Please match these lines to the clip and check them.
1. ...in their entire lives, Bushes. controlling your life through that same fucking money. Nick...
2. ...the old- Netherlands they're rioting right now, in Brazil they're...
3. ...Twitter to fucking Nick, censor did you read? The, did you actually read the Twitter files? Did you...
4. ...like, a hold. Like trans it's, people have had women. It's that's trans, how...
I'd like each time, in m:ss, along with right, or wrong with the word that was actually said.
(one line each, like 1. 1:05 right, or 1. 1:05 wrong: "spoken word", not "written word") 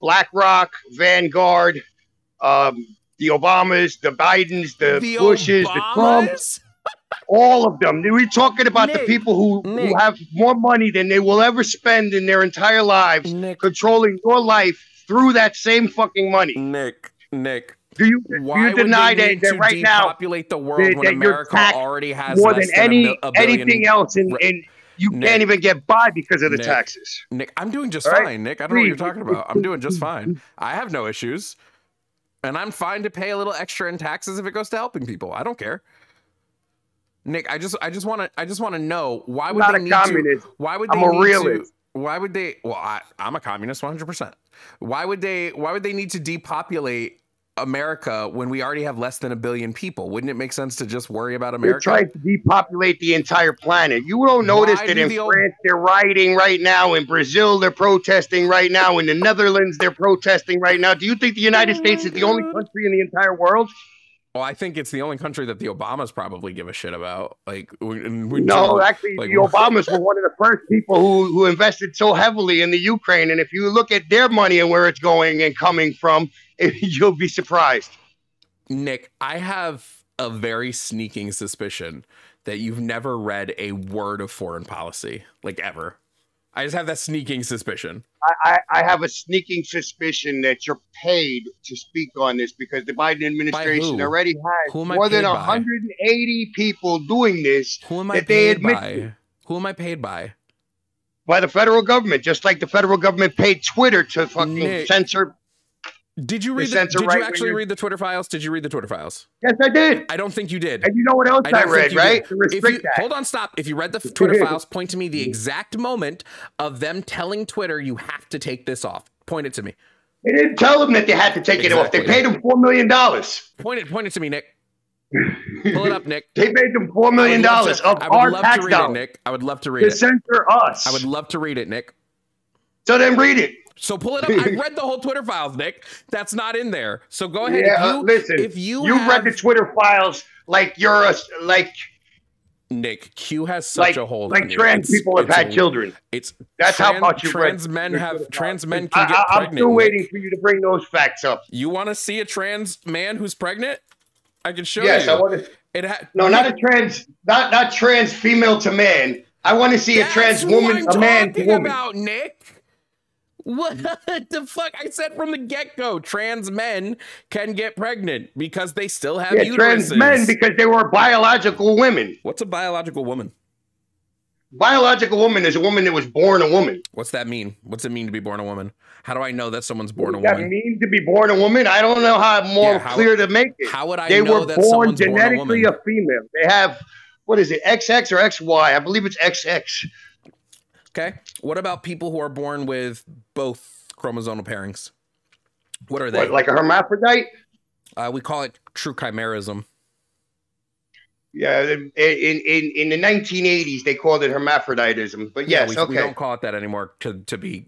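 1. 0:12 wrong: "Nick", not "Bushes"
2. 0:55 wrong: "France", not "Netherlands"
3. 1:43 right
4. 2:23 wrong: "children", not "women".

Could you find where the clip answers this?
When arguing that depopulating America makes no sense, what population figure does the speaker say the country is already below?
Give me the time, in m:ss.
0:49.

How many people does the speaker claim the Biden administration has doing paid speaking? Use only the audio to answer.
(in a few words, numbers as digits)
180.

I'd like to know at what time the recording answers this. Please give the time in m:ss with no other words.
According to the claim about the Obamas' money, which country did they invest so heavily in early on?
1:12.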